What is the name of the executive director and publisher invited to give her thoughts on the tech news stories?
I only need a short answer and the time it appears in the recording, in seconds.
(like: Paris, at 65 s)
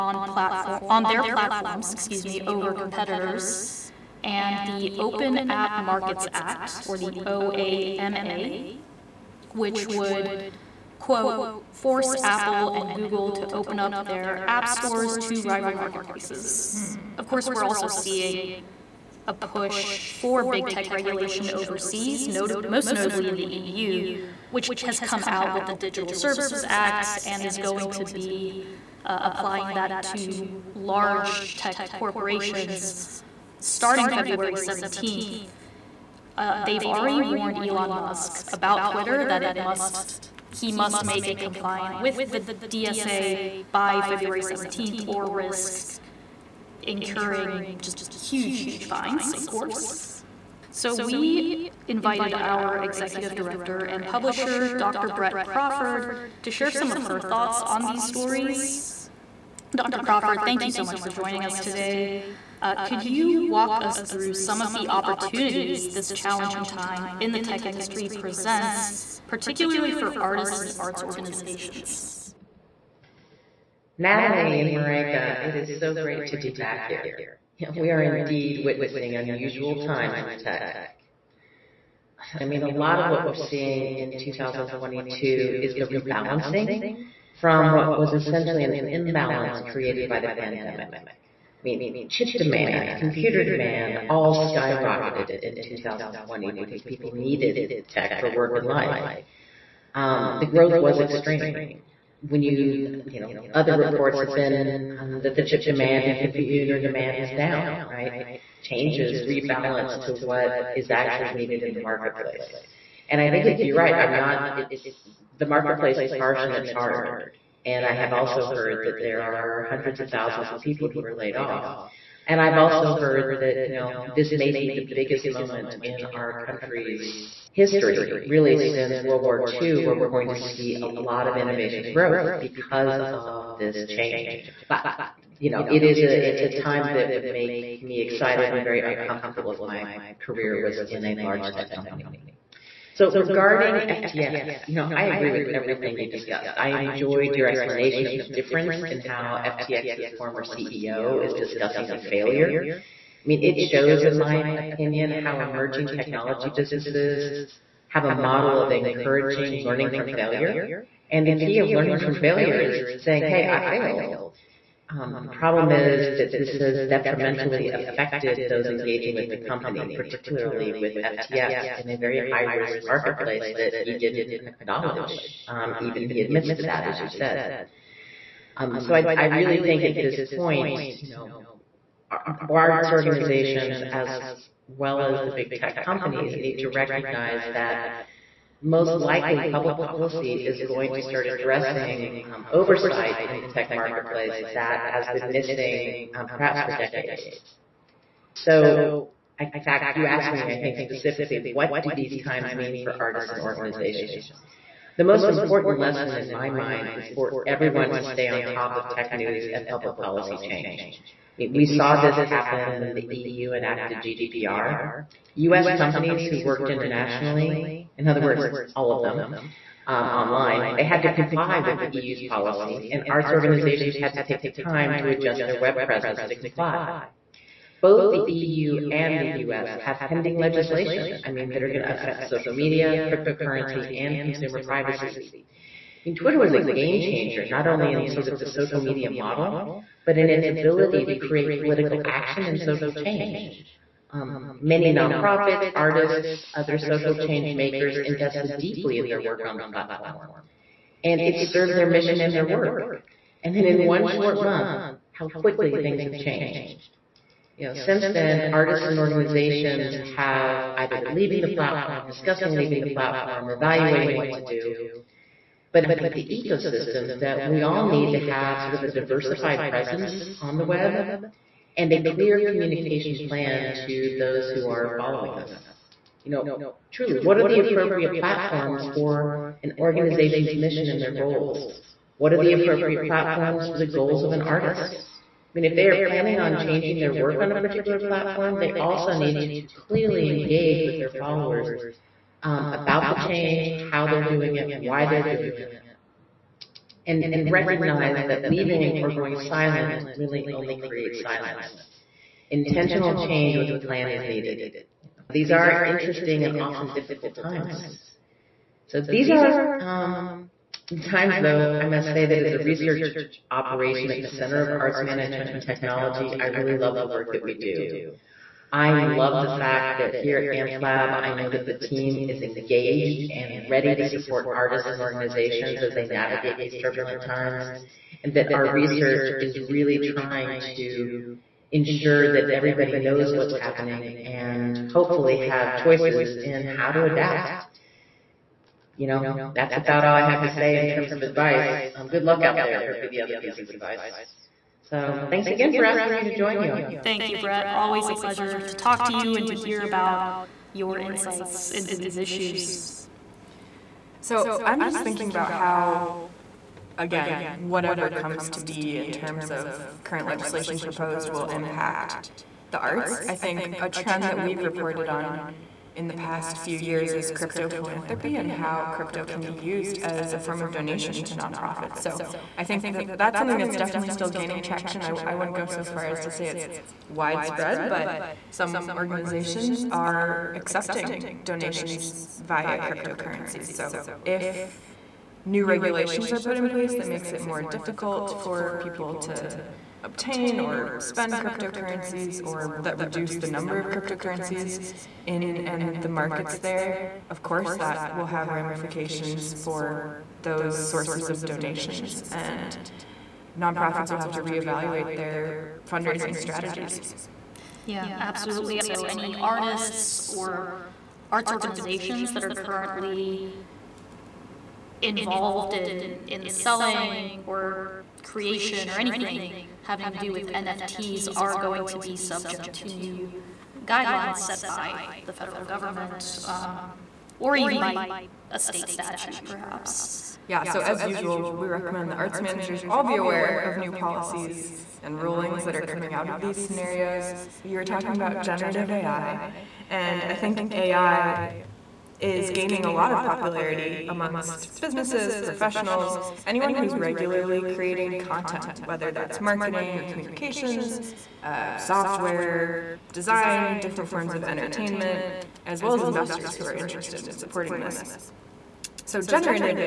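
Dr. Brett Crawford, at 54 s.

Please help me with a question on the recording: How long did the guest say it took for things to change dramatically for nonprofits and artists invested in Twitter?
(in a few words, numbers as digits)
one short month.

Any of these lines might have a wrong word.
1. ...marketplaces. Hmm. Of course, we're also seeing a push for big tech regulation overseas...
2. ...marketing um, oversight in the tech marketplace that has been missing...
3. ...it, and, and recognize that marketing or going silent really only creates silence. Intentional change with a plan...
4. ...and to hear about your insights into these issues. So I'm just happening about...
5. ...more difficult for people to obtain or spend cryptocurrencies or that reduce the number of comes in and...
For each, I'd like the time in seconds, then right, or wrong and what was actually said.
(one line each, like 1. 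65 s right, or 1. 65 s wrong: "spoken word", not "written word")
1. 15 s right
2. 191 s wrong: "addressing", not "marketing"
3. 295 s wrong: "leaving", not "marketing"
4. 349 s wrong: "thinking", not "happening"
5. 387 s wrong: "cryptocurrencies", not "comes".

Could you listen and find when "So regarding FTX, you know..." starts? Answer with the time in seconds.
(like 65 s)
142 s.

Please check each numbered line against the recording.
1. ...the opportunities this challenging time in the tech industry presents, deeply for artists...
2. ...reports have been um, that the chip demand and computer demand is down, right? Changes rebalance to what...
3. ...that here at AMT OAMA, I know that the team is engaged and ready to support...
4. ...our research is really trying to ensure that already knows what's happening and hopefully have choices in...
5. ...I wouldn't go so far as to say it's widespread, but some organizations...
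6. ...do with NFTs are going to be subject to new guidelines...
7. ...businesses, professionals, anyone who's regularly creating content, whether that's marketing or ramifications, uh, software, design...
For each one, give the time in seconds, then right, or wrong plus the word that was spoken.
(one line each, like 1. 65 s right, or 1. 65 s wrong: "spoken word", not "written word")
1. 64 s wrong: "particularly", not "deeply"
2. 103 s right
3. 319 s wrong: "Lab", not "OAMA"
4. 328 s wrong: "everybody", not "already"
5. 375 s right
6. 420 s right
7. 444 s wrong: "communications", not "ramifications".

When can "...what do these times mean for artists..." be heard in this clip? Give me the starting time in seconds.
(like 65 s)
201 s.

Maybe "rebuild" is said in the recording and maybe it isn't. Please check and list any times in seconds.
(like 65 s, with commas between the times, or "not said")
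not said.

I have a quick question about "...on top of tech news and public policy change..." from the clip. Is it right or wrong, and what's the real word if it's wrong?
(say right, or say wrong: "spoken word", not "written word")
right.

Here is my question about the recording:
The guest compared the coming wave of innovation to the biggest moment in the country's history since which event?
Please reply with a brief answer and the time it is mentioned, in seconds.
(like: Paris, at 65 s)
World War II, at 129 s.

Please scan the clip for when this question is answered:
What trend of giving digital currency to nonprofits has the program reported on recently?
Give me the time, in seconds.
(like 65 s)
367 s.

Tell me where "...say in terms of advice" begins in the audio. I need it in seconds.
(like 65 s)
340 s.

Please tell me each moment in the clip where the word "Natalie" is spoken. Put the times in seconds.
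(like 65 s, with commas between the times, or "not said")
74 s.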